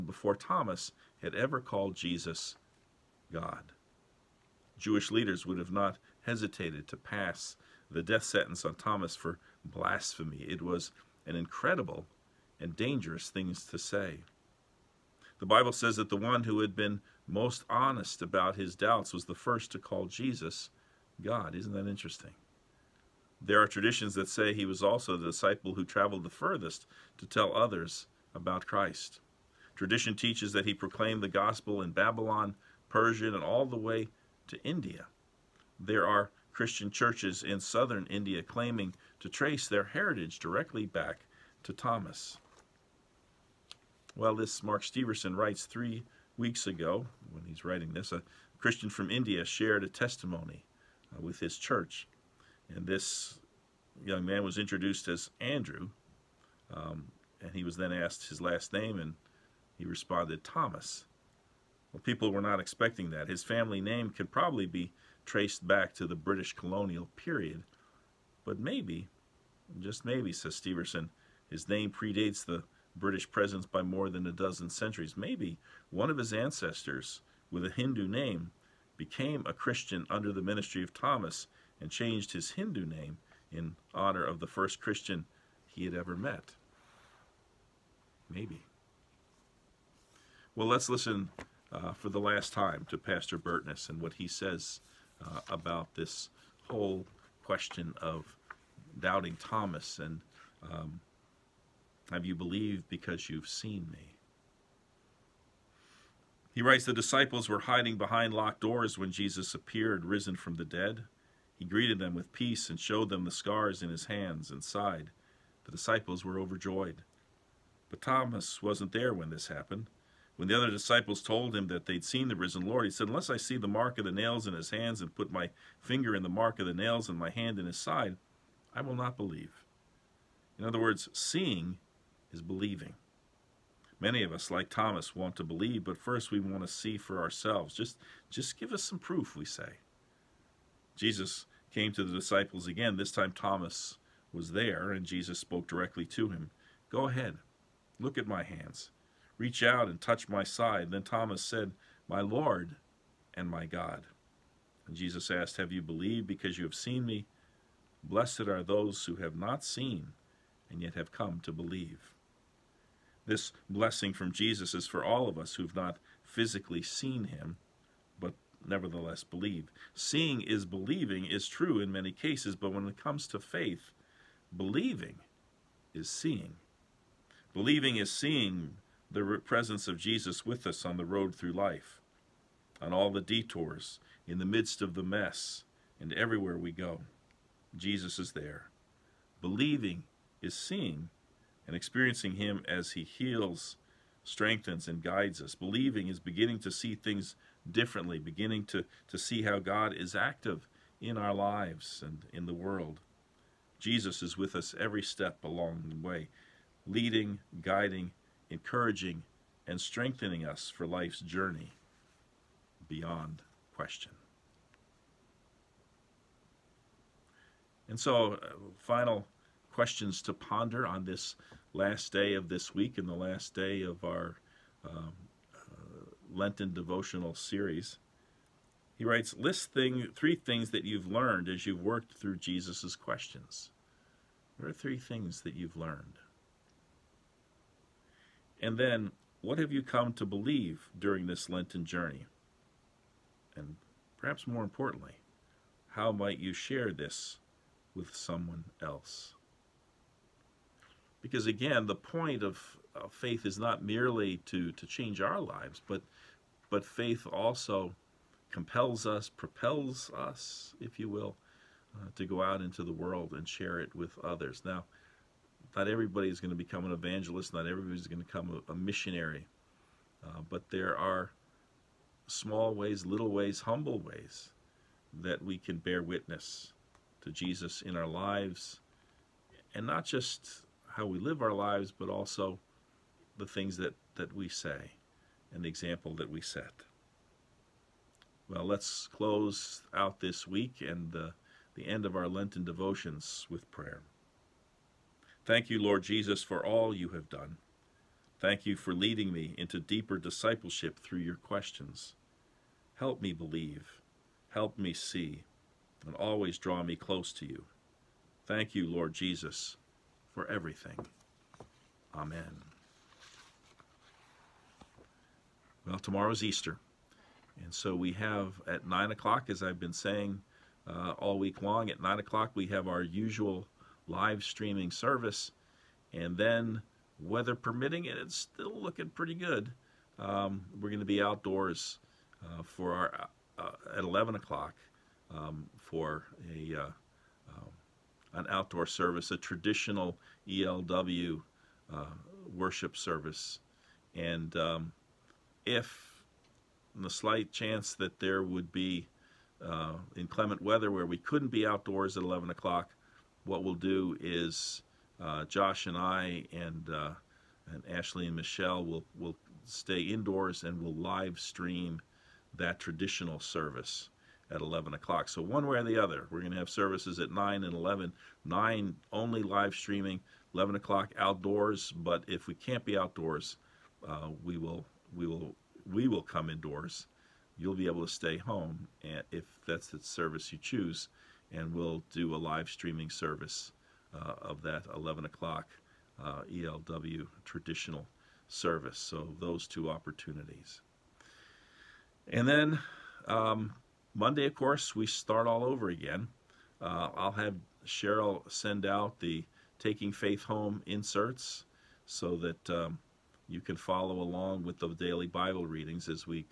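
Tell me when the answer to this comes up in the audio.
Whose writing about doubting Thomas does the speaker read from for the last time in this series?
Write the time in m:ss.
1:32.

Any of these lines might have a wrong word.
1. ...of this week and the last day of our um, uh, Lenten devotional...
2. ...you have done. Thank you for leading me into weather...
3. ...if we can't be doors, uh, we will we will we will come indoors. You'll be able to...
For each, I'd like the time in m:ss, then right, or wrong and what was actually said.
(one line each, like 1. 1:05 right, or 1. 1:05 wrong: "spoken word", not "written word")
1. 3:42 right
2. 4:56 wrong: "deeper", not "weather"
3. 6:12 wrong: "outdoors", not "doors".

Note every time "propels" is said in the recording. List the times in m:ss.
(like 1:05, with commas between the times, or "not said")
4:19.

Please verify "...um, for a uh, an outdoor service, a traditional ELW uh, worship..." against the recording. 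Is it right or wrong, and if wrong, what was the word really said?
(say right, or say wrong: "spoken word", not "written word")
right.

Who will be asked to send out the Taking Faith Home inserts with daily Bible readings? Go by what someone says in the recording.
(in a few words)
Cheryl.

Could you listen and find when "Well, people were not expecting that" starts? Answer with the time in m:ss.
1:01.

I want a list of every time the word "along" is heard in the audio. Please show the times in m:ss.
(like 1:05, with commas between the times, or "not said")
3:25, 6:44.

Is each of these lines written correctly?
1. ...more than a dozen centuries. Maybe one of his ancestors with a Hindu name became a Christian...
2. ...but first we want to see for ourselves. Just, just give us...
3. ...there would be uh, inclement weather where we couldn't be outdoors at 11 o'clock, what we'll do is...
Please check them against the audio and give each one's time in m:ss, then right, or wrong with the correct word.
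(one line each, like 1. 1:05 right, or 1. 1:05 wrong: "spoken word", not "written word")
1. 1:13 right
2. 2:15 right
3. 5:48 right.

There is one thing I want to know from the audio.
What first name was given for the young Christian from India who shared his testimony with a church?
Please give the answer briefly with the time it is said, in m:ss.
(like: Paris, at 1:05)
Andrew, at 0:55.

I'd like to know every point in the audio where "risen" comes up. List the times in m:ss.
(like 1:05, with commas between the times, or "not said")
1:50, 2:02.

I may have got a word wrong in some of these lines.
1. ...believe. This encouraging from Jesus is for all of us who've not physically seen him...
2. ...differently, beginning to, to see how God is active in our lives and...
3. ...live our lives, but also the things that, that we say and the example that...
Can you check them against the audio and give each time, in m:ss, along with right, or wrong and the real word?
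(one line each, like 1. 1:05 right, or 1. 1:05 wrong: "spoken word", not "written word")
1. 2:41 wrong: "blessing", not "encouraging"
2. 3:17 right
3. 4:41 right.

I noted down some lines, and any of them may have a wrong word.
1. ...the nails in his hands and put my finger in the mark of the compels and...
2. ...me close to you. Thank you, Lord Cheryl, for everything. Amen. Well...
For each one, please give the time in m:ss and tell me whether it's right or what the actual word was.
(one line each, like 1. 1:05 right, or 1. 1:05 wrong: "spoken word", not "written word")
1. 2:04 wrong: "nails", not "compels"
2. 5:06 wrong: "Jesus", not "Cheryl".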